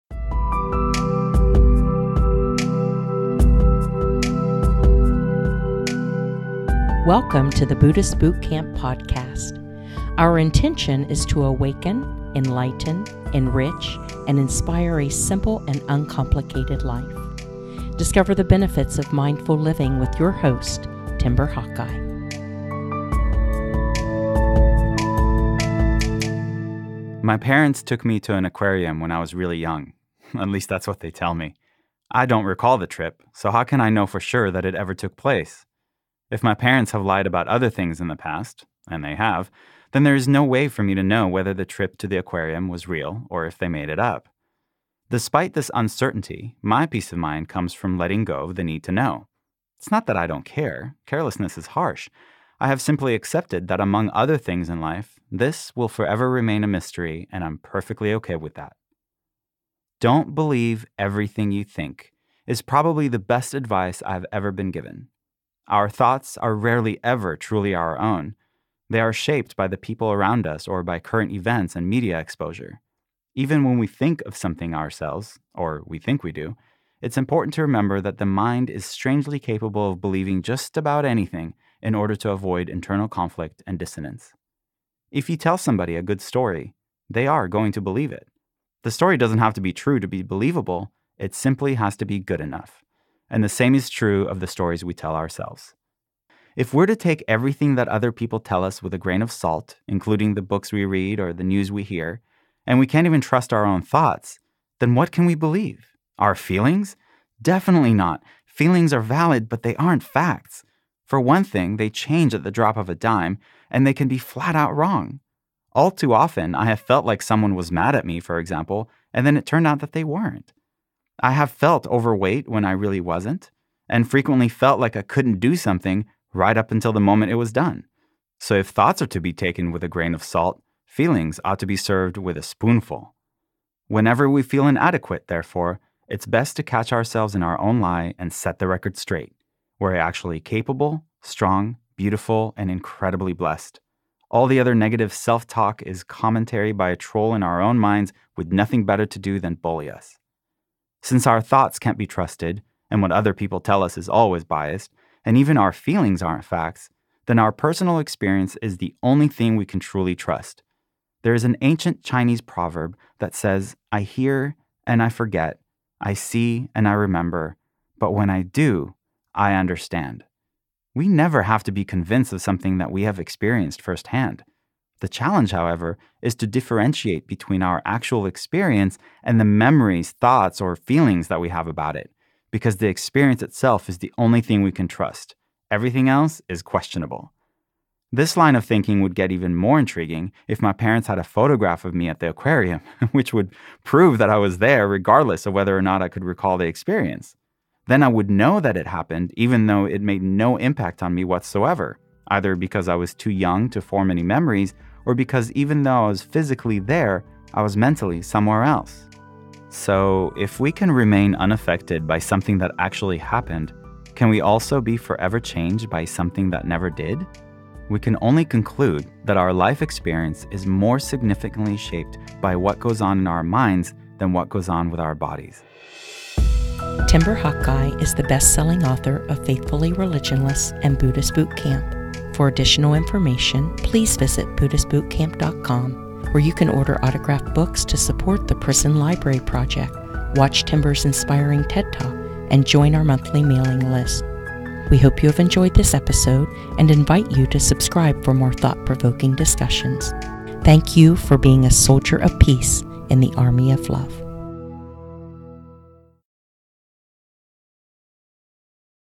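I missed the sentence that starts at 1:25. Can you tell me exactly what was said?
If you tell somebody a good story, they are going to believe it.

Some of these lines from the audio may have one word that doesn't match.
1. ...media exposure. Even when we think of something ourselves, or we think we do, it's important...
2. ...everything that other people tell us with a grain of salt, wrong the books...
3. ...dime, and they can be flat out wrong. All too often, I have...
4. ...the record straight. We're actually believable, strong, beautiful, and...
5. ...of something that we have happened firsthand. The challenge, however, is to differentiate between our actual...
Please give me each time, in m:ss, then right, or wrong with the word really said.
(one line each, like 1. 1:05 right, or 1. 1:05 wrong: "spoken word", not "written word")
1. 1:11 right
2. 1:37 wrong: "including", not "wrong"
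3. 1:52 right
4. 2:18 wrong: "capable", not "believable"
5. 2:52 wrong: "experienced", not "happened".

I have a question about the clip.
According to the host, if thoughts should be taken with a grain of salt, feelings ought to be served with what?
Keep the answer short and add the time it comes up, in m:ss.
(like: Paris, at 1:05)
A spoonful, at 2:12.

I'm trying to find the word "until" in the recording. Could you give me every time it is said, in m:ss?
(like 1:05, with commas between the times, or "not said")
2:06.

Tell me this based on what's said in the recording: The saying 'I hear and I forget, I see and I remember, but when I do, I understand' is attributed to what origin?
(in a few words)
Ancient Chinese proverb.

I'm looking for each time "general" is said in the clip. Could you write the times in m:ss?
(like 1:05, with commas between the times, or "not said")
not said.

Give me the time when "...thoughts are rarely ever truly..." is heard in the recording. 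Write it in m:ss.
1:05.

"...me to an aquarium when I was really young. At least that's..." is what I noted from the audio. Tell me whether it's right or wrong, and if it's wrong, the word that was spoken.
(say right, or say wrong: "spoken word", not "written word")
right.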